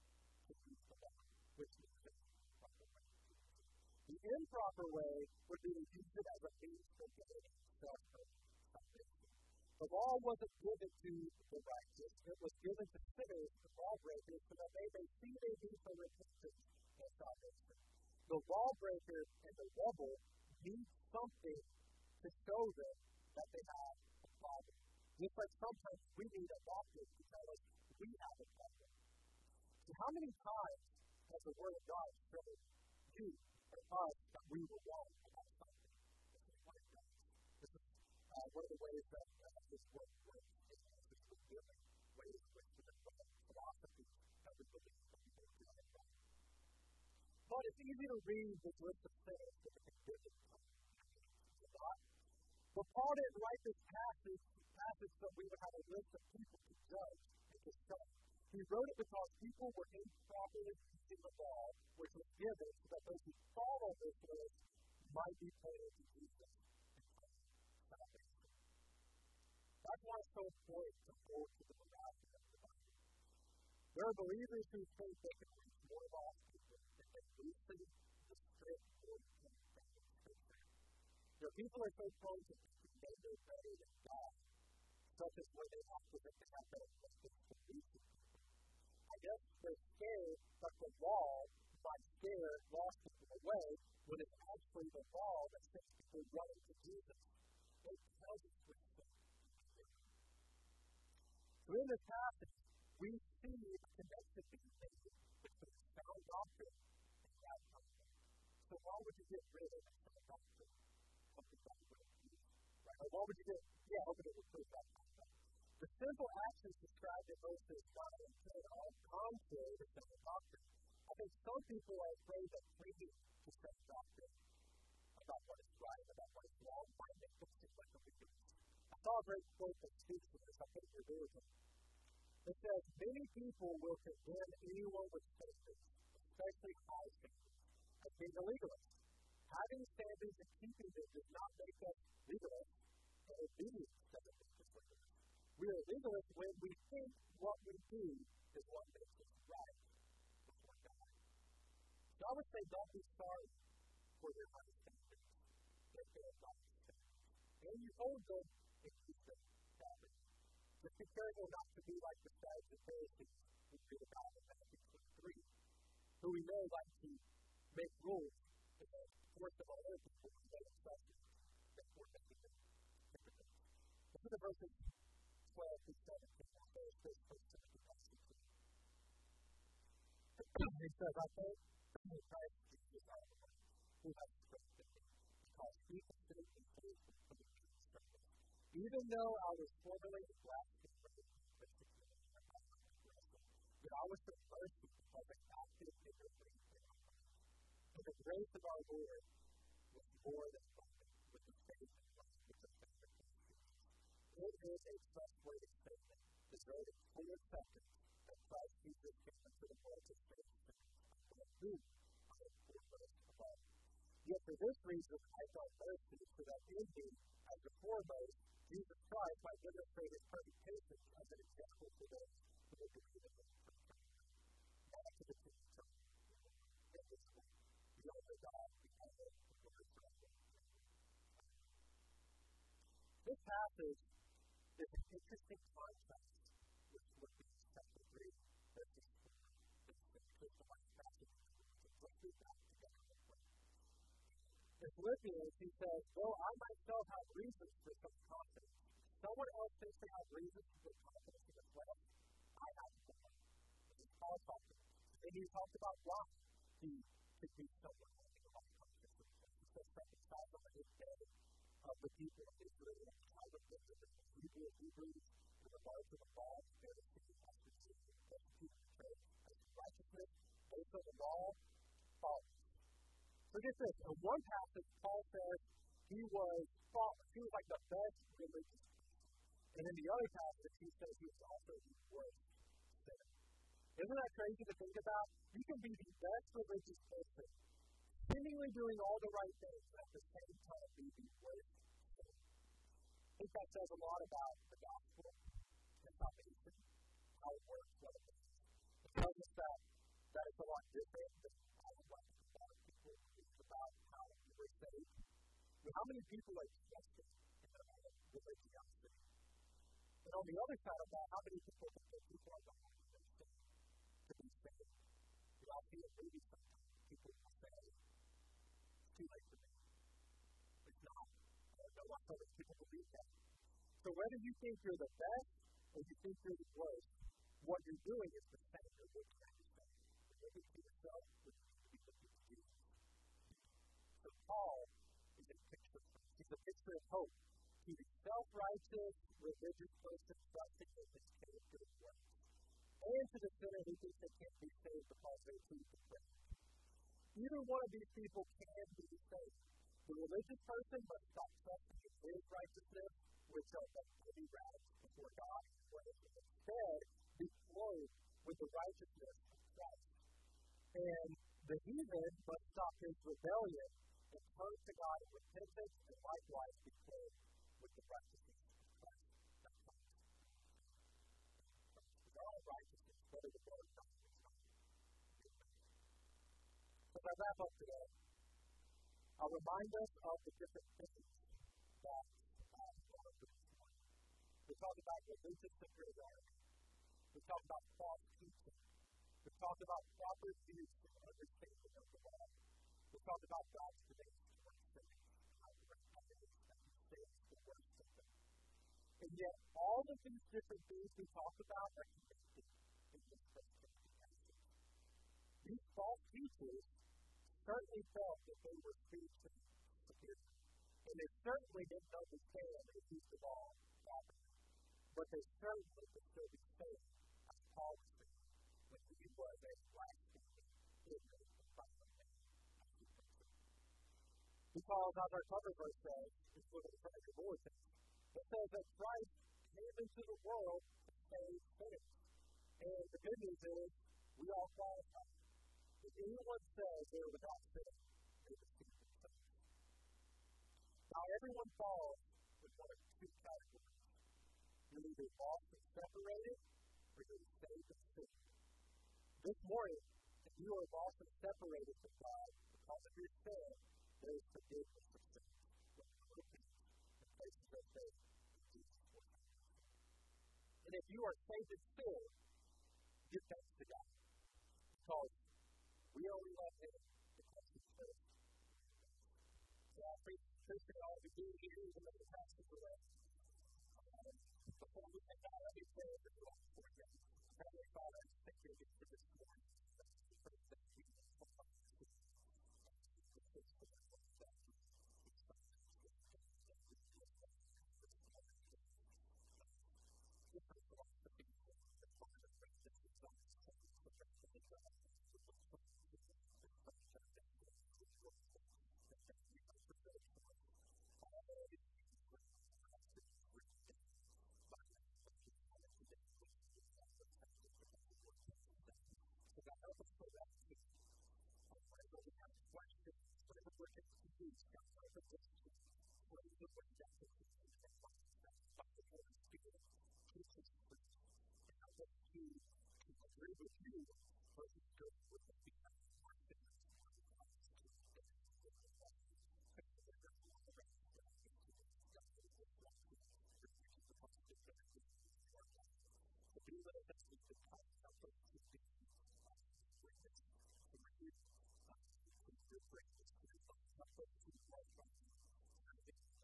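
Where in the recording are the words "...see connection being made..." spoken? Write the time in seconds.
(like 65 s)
103 s.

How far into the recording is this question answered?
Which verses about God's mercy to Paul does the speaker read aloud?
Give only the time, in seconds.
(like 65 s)
174 s.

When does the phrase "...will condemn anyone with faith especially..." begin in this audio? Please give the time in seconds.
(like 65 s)
133 s.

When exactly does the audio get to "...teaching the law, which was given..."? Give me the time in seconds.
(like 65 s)
60 s.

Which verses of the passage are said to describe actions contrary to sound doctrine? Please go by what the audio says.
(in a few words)
verses 9 and 10.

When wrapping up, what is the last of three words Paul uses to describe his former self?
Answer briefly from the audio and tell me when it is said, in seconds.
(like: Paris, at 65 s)
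violent, at 421 s.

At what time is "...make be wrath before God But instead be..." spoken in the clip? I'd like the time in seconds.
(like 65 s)
353 s.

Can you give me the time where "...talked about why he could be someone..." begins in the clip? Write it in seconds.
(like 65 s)
255 s.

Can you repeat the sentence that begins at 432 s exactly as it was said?
And the good news is, we all qualify if anyone says they are without sin, they deceive themselves.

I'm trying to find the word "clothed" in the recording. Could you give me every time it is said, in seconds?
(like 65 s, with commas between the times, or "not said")
357 s, 367 s.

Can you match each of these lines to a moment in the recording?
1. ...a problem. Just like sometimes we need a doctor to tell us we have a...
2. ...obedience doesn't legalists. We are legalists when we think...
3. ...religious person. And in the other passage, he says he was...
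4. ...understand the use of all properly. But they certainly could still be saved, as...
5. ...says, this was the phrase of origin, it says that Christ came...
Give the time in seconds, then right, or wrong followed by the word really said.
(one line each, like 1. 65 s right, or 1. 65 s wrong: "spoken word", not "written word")
1. 24 s right
2. 143 s right
3. 278 s right
4. 412 s right
5. 426 s right.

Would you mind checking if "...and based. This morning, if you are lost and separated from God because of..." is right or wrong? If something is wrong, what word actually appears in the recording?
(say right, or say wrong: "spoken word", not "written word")
wrong: "saved", not "based".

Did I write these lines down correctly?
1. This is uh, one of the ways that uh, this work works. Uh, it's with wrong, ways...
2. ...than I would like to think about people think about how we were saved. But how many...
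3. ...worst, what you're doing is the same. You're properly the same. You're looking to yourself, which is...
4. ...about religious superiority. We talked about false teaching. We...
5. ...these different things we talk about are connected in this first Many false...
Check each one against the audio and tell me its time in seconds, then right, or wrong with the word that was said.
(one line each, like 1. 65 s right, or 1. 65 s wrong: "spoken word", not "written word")
1. 37 s wrong: "giving", not "wrong"
2. 301 s right
3. 326 s wrong: "exactly", not "properly"
4. 385 s right
5. 400 s wrong: "These", not "Many".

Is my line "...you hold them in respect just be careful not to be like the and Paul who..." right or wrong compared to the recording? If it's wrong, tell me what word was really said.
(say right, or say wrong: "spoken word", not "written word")
wrong: "Sadducees", not "Paul".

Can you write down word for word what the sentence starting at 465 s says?
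Because We only love him because he's first, not first.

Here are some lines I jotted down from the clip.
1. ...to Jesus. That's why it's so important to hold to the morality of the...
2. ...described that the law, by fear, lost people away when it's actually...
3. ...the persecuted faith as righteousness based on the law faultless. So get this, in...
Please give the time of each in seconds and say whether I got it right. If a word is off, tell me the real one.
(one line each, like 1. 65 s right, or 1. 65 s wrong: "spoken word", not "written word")
1. 65 s right
2. 89 s wrong: "scared", not "described"
3. 268 s right.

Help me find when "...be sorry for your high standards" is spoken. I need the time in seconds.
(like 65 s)
152 s.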